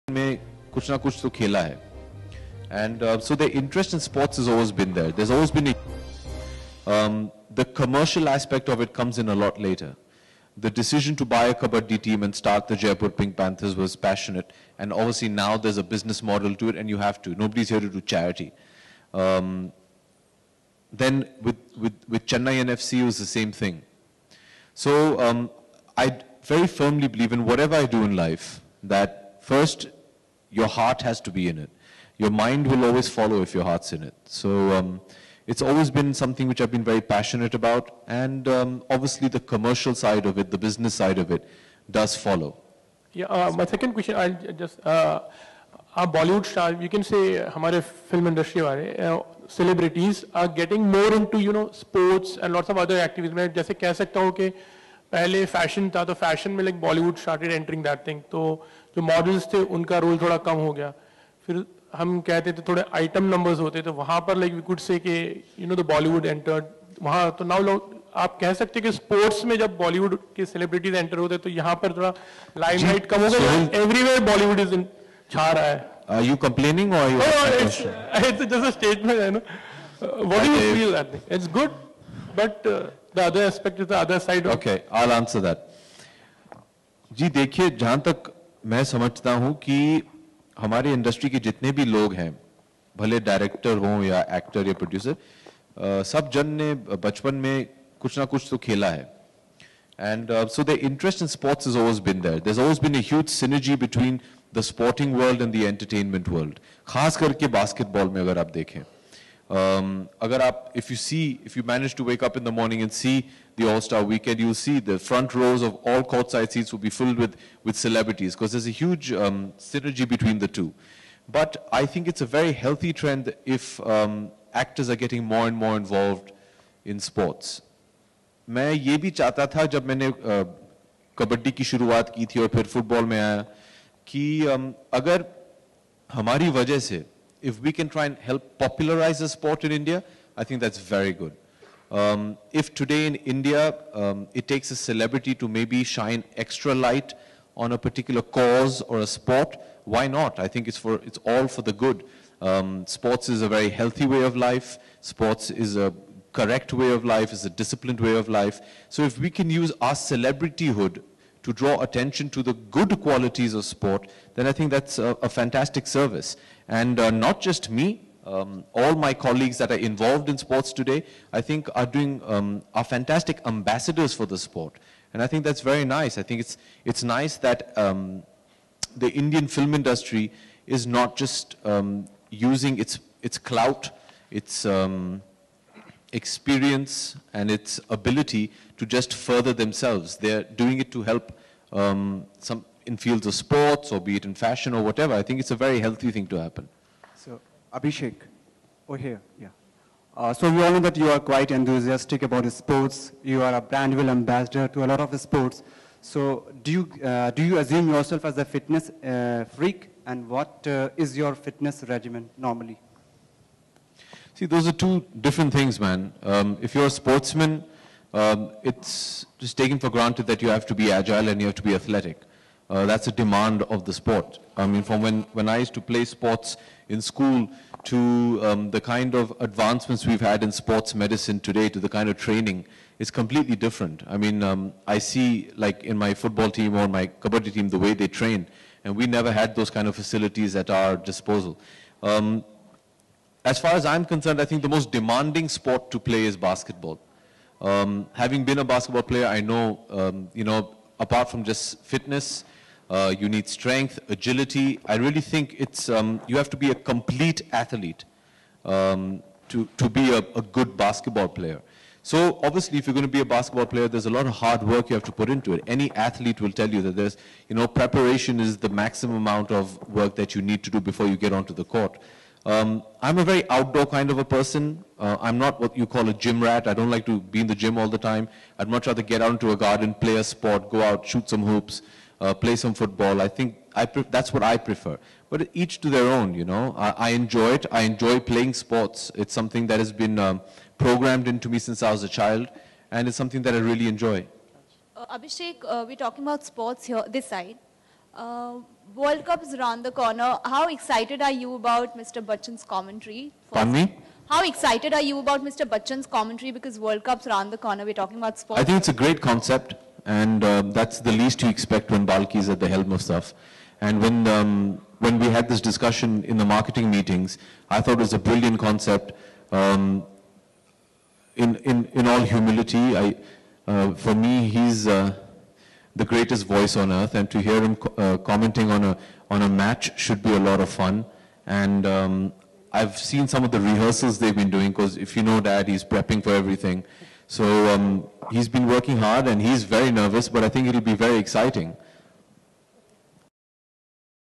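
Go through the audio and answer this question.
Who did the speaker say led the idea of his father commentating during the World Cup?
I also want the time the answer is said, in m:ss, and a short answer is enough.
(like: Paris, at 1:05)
Balki, at 5:12.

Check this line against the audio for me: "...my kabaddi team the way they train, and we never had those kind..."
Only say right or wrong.
right.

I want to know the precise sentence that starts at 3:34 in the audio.
See, those are two different things, man.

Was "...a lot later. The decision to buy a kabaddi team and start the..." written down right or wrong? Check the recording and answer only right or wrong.
right.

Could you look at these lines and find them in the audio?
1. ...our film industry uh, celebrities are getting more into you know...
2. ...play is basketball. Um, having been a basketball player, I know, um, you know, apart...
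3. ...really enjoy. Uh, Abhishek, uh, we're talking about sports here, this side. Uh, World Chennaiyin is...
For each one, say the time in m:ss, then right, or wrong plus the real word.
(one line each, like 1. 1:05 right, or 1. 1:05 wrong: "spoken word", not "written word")
1. 0:47 right
2. 4:05 right
3. 4:53 wrong: "Cup", not "Chennaiyin".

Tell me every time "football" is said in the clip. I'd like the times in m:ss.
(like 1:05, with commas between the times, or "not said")
3:56, 4:42.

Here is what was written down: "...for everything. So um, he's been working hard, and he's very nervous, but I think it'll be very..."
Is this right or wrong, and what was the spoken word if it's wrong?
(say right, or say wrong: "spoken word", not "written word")
right.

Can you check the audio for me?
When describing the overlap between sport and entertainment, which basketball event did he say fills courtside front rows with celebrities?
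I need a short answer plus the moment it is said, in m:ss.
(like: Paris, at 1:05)
All-Star weekend, at 1:53.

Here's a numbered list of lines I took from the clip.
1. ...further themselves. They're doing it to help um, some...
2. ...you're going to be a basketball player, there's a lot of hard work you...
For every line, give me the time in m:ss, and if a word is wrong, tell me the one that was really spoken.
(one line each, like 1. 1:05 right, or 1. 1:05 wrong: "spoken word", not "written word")
1. 3:09 right
2. 4:22 right.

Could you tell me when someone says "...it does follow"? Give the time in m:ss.
0:41.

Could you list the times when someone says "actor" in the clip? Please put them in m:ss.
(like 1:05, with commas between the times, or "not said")
1:34, 2:04.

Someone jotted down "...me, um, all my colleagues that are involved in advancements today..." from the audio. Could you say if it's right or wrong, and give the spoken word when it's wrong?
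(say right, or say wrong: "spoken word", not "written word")
wrong: "sports", not "advancements".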